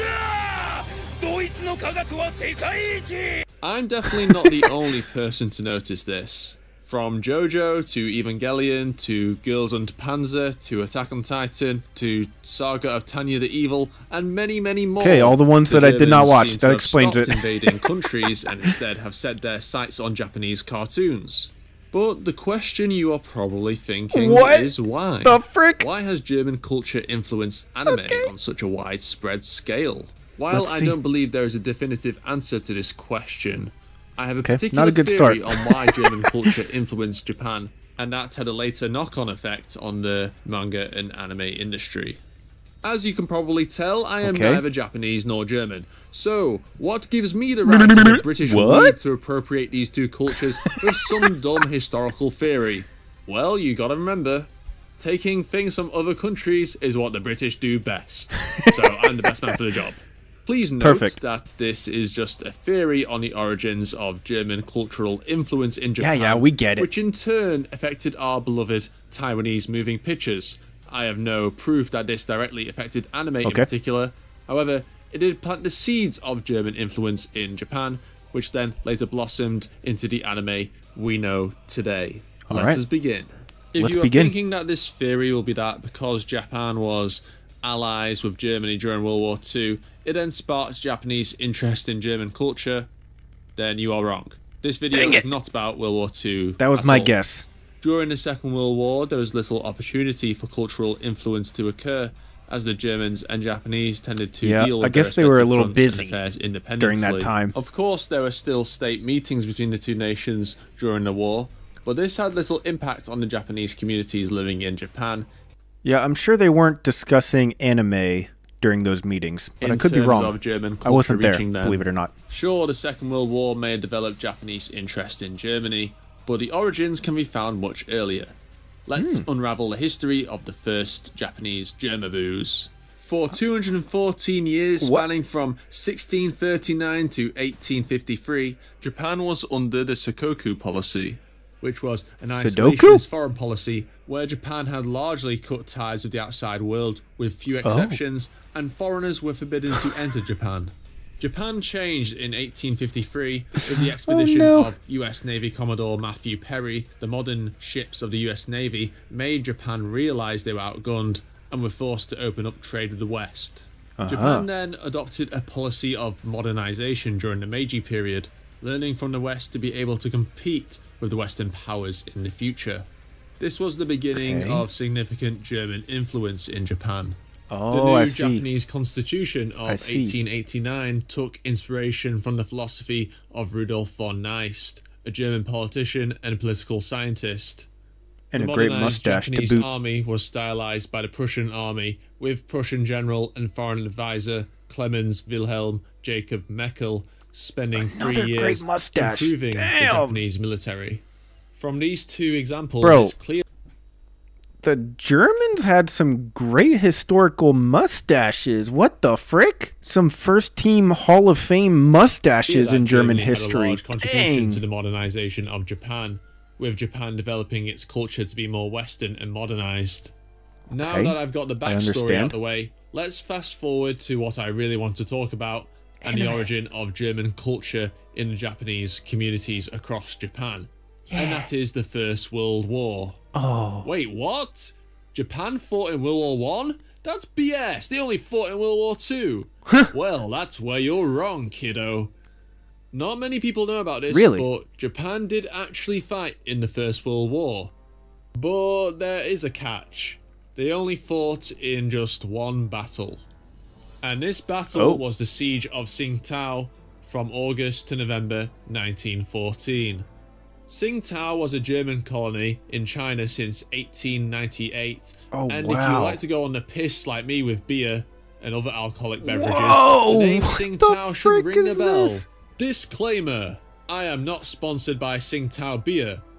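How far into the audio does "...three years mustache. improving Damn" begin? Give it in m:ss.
3:18.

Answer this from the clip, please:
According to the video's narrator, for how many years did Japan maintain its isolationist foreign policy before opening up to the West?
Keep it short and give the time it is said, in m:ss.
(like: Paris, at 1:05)
214, at 2:13.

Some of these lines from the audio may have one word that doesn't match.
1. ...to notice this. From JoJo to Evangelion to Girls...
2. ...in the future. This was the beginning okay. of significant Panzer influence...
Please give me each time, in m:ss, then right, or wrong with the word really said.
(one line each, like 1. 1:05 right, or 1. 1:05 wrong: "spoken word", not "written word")
1. 0:05 right
2. 2:52 wrong: "German", not "Panzer".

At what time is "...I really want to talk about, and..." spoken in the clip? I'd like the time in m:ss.
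3:44.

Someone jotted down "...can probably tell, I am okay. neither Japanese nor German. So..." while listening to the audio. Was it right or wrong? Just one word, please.
right.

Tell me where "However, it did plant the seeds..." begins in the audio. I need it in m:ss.
1:14.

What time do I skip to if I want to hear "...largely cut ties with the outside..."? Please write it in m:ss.
2:24.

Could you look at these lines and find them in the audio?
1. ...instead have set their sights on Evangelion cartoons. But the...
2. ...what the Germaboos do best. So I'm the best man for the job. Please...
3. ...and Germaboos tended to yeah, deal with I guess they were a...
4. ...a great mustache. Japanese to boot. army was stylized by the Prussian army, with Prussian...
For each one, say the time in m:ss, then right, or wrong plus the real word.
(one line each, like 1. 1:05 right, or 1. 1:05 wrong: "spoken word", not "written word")
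1. 0:18 wrong: "Japanese", not "Evangelion"
2. 0:56 wrong: "British", not "Germaboos"
3. 1:43 wrong: "Japanese", not "Germaboos"
4. 3:08 right.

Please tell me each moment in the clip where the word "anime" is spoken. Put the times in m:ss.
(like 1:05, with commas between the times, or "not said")
0:27, 0:41, 1:13, 1:20, 1:57.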